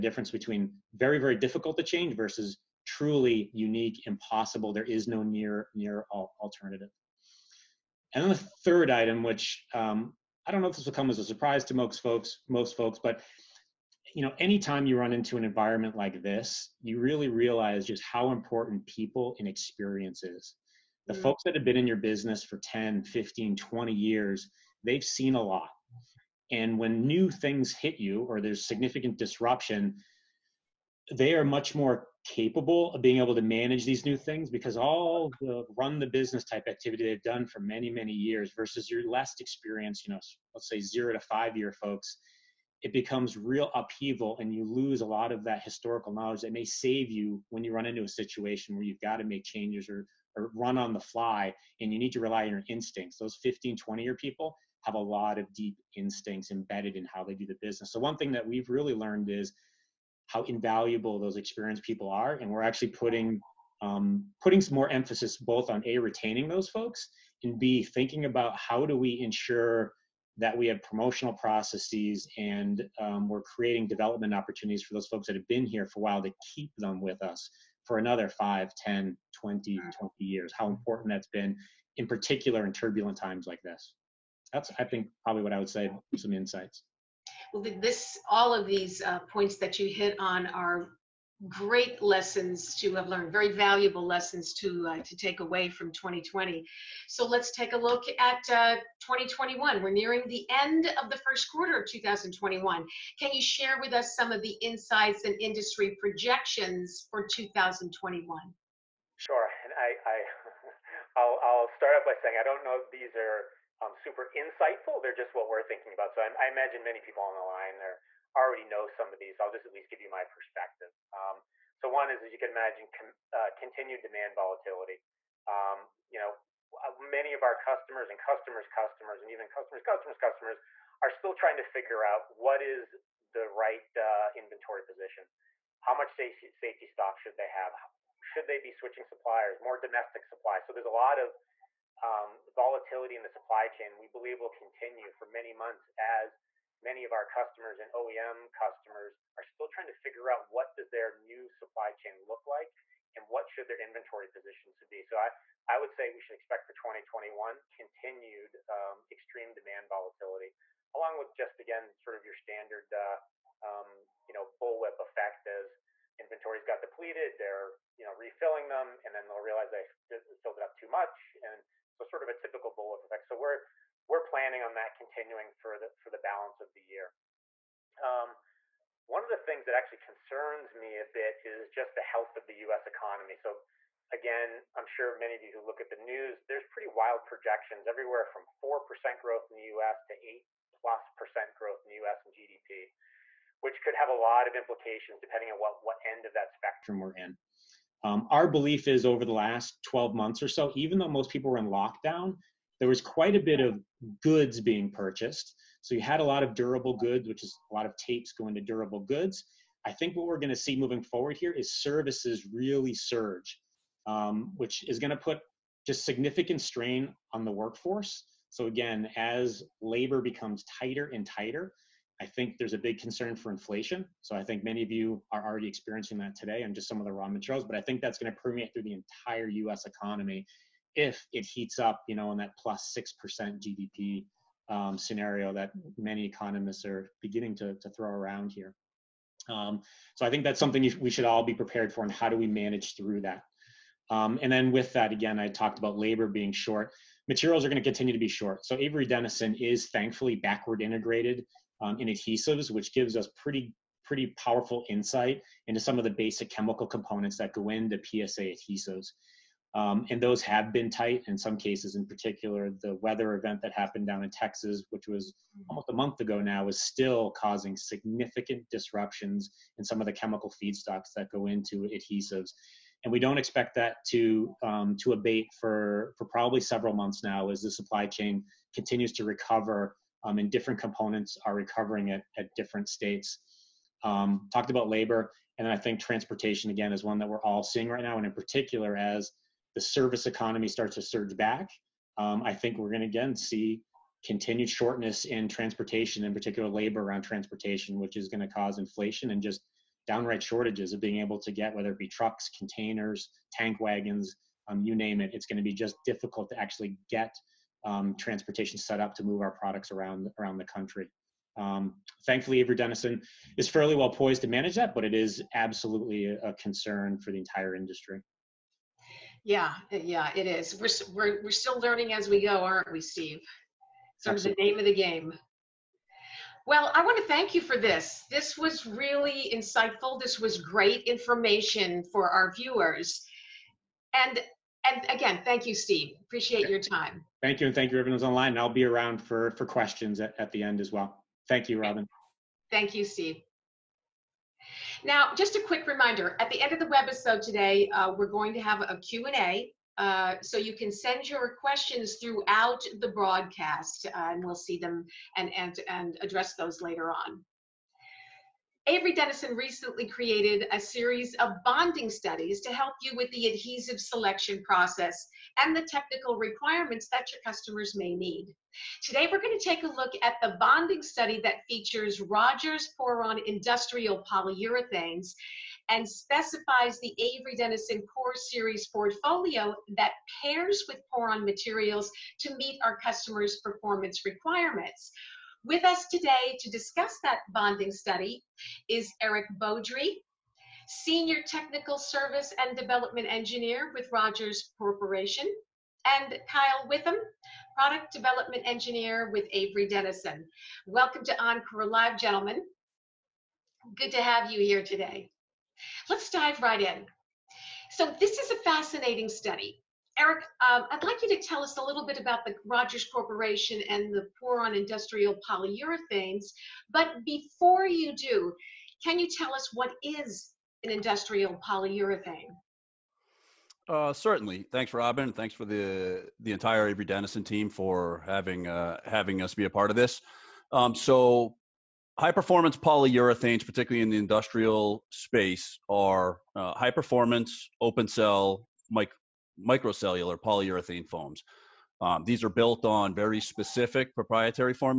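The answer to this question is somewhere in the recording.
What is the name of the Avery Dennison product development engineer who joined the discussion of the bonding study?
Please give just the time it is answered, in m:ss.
6:36.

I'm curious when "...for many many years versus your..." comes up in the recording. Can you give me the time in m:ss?
0:37.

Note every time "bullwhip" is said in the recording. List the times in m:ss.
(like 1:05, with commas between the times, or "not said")
2:44, 2:52.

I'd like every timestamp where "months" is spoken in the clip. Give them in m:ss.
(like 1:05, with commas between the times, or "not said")
2:25, 3:20, 4:25, 4:36.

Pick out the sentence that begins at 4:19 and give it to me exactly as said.
Um, and those have been tight in some cases, in particular, the weather event that happened down in Texas, which was mm.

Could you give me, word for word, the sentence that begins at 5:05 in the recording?
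It's going to be just difficult to actually get um, transportation set up to move our products around around the country.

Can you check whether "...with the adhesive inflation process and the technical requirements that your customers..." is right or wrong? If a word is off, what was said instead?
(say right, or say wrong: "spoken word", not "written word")
wrong: "selection", not "inflation".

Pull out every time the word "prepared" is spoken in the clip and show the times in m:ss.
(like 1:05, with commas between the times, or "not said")
4:01.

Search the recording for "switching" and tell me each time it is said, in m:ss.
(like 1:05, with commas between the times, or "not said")
2:18.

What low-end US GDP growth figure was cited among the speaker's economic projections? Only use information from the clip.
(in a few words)
4%.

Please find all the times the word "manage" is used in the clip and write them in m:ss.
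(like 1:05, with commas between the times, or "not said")
0:33, 4:02, 5:14.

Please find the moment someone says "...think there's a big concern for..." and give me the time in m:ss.
3:42.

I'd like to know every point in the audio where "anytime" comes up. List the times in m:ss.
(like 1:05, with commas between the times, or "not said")
0:14.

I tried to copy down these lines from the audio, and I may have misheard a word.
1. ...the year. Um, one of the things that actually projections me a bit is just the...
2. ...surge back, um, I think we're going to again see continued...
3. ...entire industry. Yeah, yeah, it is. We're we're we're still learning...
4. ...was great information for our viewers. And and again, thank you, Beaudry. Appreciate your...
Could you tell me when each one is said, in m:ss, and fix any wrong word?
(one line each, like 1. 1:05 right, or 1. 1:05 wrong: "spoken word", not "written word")
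1. 2:56 wrong: "concerns", not "projections"
2. 4:51 right
3. 5:17 right
4. 5:30 wrong: "Steve", not "Beaudry".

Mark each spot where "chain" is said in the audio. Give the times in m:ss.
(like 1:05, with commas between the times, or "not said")
2:23, 2:31, 4:38.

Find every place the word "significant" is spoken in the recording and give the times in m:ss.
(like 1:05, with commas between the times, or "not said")
0:28, 3:36, 4:27.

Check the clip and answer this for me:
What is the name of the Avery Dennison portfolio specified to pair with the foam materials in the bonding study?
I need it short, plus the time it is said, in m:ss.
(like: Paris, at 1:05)
Core Series, at 6:18.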